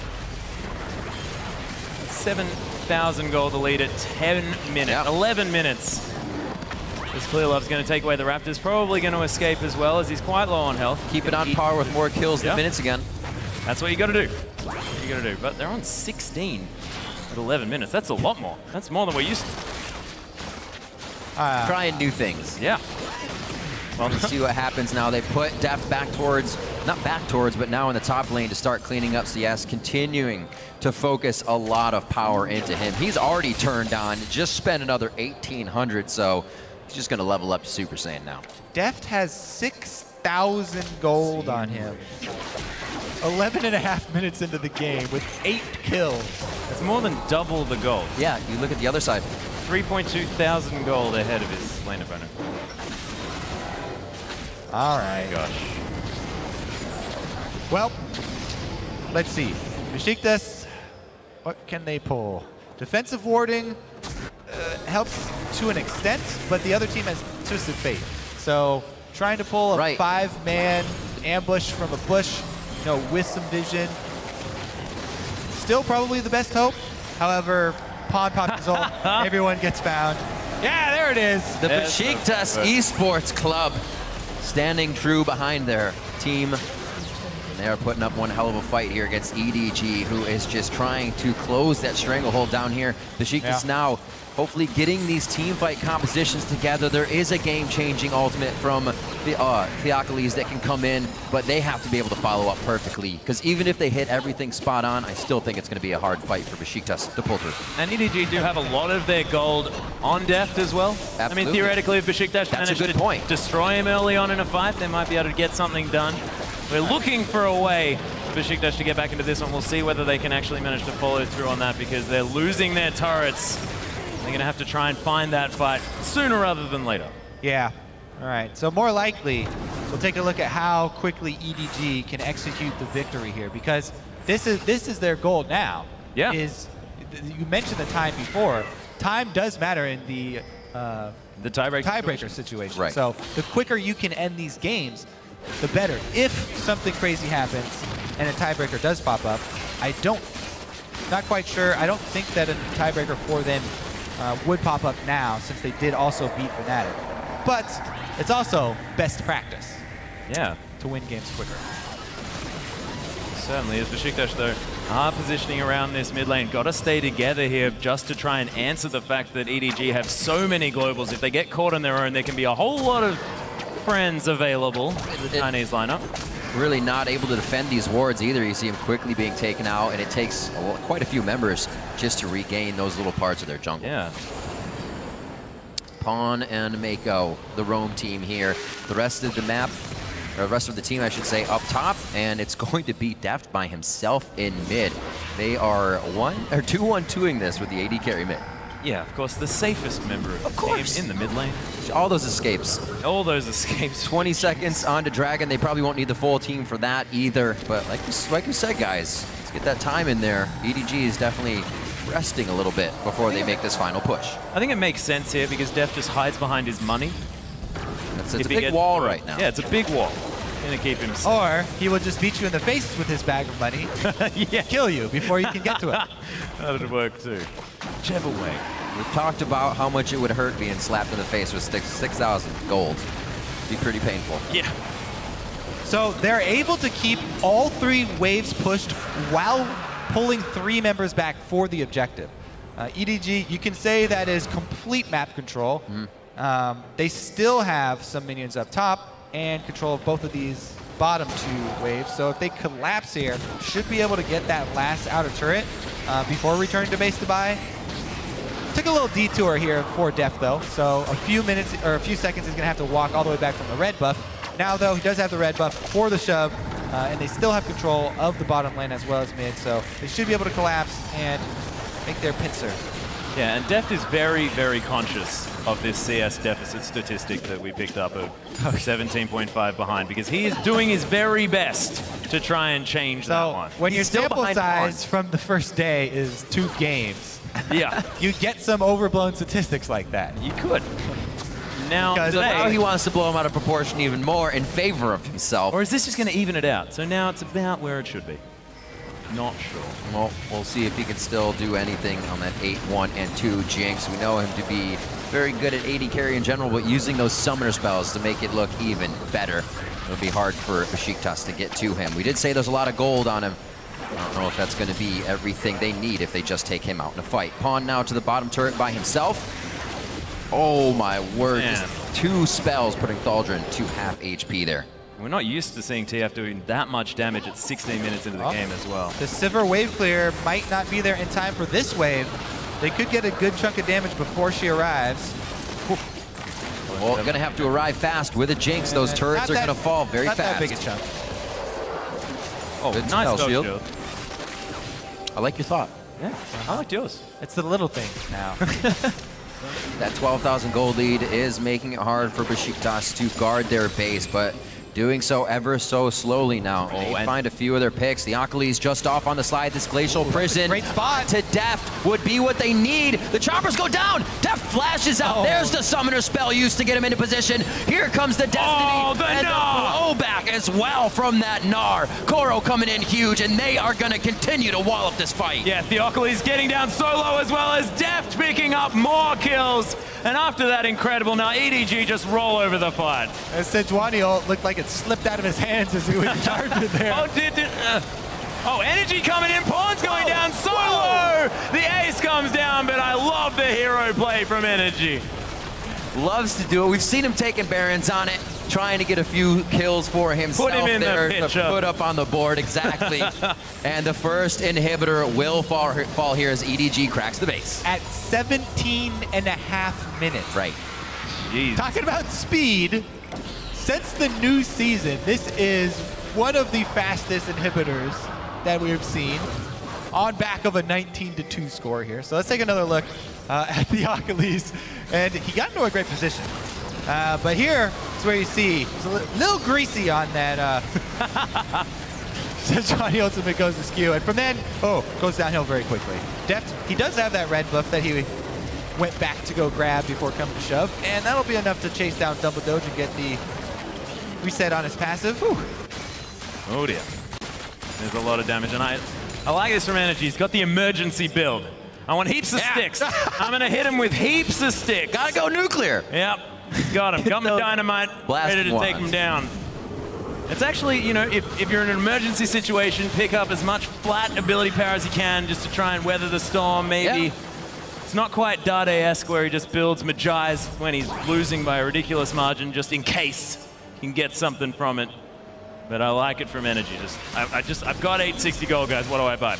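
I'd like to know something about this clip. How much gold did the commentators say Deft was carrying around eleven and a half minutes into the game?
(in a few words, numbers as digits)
6,000.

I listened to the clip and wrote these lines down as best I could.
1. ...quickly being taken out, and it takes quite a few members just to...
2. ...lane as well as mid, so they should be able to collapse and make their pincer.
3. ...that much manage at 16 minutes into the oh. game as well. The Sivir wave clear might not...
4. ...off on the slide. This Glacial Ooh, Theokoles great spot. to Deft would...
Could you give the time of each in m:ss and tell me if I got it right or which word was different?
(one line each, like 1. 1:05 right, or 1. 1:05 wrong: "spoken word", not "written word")
1. 2:58 right
2. 4:28 right
3. 5:26 wrong: "damage", not "manage"
4. 5:59 wrong: "Prison", not "Theokoles".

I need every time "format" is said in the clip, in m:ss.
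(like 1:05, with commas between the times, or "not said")
not said.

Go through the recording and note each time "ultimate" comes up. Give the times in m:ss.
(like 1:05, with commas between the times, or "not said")
1:38, 7:13.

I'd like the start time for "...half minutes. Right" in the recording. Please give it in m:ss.
6:49.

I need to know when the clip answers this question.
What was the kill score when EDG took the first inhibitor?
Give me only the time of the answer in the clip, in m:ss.
7:00.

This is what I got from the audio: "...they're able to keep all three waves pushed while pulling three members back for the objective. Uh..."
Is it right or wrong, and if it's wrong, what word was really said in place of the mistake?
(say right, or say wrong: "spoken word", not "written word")
right.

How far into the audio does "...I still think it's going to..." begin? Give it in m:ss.
1:45.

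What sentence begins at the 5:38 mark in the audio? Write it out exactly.
Those turrets are going to fall very not fast.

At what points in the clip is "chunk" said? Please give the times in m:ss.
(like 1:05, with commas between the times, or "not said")
5:33, 5:40.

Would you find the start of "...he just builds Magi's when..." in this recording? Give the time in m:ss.
7:49.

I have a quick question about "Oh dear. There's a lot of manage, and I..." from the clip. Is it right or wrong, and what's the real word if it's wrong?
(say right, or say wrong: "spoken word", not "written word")
wrong: "damage", not "manage".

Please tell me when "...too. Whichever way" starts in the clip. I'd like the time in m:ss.
3:47.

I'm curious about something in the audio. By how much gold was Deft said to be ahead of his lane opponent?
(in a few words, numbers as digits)
3.2 thousand.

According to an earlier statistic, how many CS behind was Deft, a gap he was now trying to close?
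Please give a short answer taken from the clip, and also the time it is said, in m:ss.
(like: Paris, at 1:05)
17.5, at 4:38.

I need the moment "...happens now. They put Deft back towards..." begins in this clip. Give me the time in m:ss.
0:24.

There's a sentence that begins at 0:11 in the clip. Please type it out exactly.
Keep it on par with more kills yeah.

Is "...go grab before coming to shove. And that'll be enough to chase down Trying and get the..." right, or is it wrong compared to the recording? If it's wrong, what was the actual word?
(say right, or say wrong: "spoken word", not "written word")
wrong: "Dumbledoge", not "Trying".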